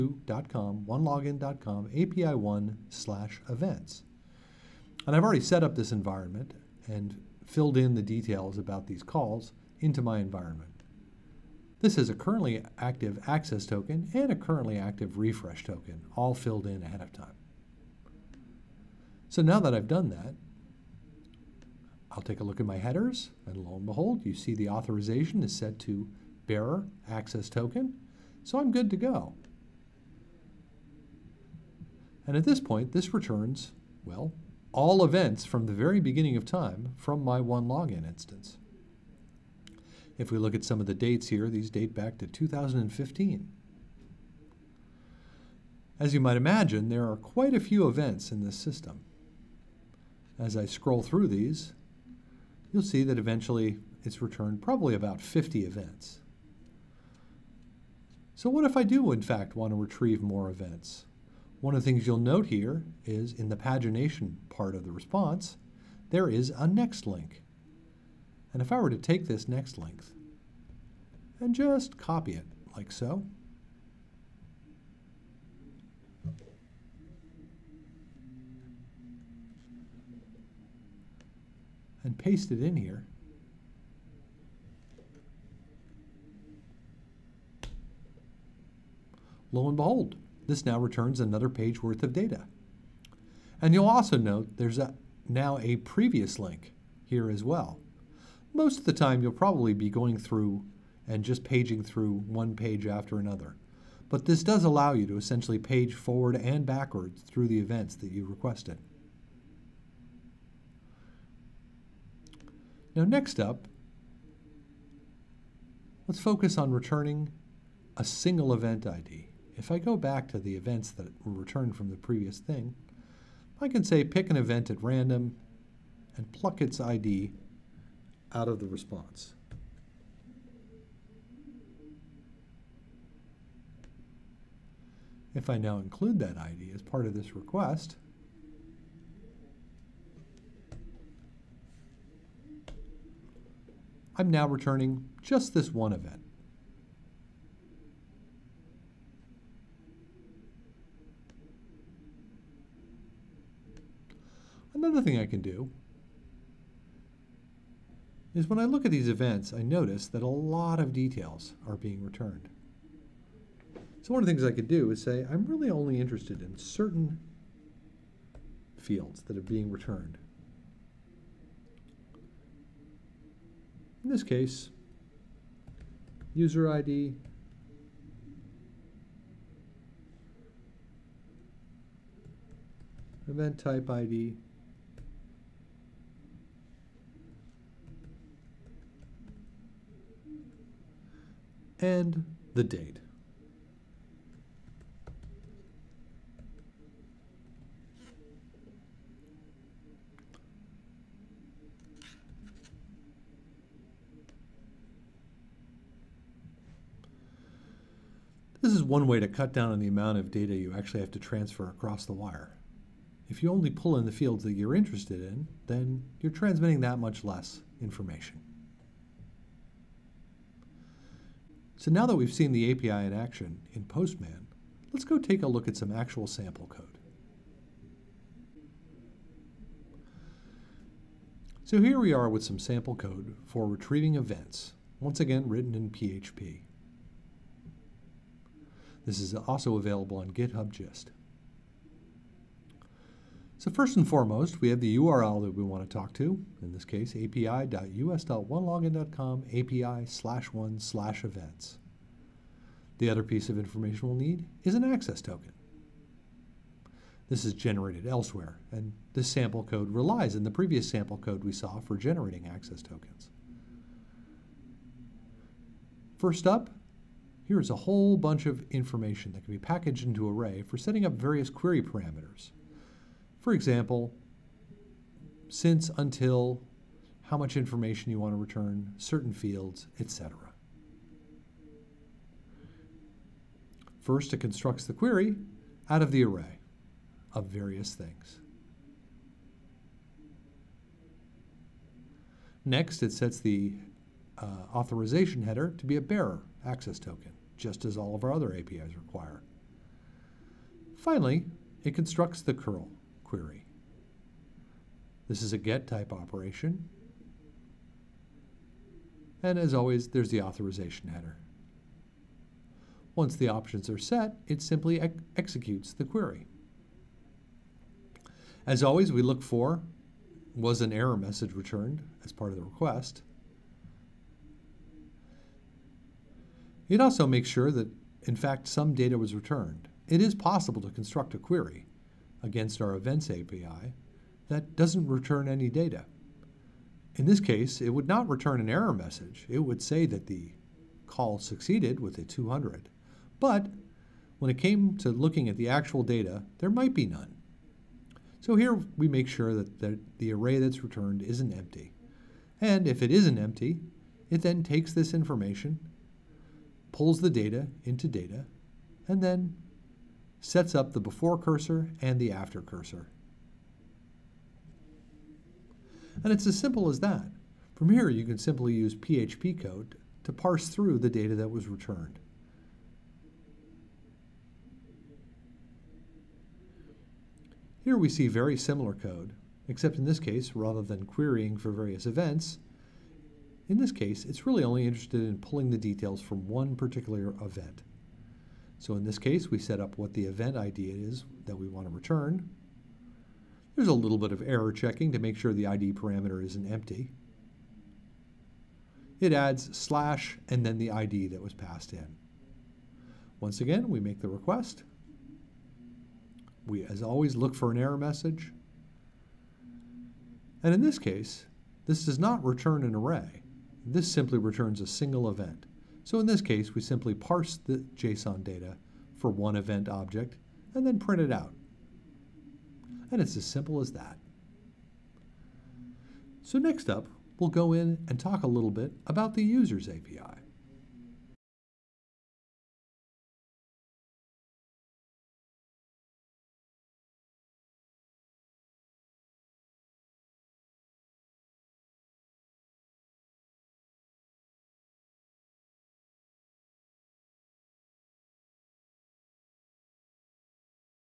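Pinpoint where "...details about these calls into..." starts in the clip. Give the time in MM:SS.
00:08.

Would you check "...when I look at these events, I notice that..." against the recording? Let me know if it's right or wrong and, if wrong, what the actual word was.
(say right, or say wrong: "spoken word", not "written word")
right.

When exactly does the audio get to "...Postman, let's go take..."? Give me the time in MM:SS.
03:43.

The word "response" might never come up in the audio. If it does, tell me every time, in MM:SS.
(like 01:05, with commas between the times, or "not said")
01:04, 02:08.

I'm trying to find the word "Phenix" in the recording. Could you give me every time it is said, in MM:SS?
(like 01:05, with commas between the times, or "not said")
not said.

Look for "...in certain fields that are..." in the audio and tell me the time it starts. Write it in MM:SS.
02:46.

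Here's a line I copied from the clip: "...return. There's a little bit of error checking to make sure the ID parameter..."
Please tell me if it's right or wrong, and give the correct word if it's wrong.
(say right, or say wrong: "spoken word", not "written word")
right.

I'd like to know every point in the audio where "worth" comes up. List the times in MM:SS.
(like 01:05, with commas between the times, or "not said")
01:31.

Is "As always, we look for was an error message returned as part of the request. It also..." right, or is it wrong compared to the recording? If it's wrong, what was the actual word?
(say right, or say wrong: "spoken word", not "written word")
right.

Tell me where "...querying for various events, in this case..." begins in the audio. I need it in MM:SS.
06:21.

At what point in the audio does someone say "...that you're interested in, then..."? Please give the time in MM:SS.
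03:34.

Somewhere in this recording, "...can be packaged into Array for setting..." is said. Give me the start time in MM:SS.
04:29.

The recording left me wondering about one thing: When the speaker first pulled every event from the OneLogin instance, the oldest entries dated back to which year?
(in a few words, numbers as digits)
2015.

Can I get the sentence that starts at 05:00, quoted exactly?
Finally, it constructs the curl, query.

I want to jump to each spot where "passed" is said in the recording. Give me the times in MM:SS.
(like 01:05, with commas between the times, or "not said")
06:41.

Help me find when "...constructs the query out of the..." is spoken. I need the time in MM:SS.
04:44.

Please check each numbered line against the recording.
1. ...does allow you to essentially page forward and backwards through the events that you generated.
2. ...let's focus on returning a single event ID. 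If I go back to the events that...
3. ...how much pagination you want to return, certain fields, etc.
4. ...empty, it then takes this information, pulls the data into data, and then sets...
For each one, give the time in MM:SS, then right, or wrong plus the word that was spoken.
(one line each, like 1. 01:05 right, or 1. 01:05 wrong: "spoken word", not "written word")
1. 01:44 wrong: "requested", not "generated"
2. 01:56 right
3. 04:37 wrong: "information", not "pagination"
4. 05:53 right.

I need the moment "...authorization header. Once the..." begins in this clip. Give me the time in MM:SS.
05:10.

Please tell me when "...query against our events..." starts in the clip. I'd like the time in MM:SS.
05:31.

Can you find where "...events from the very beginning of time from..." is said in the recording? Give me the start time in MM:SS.
00:35.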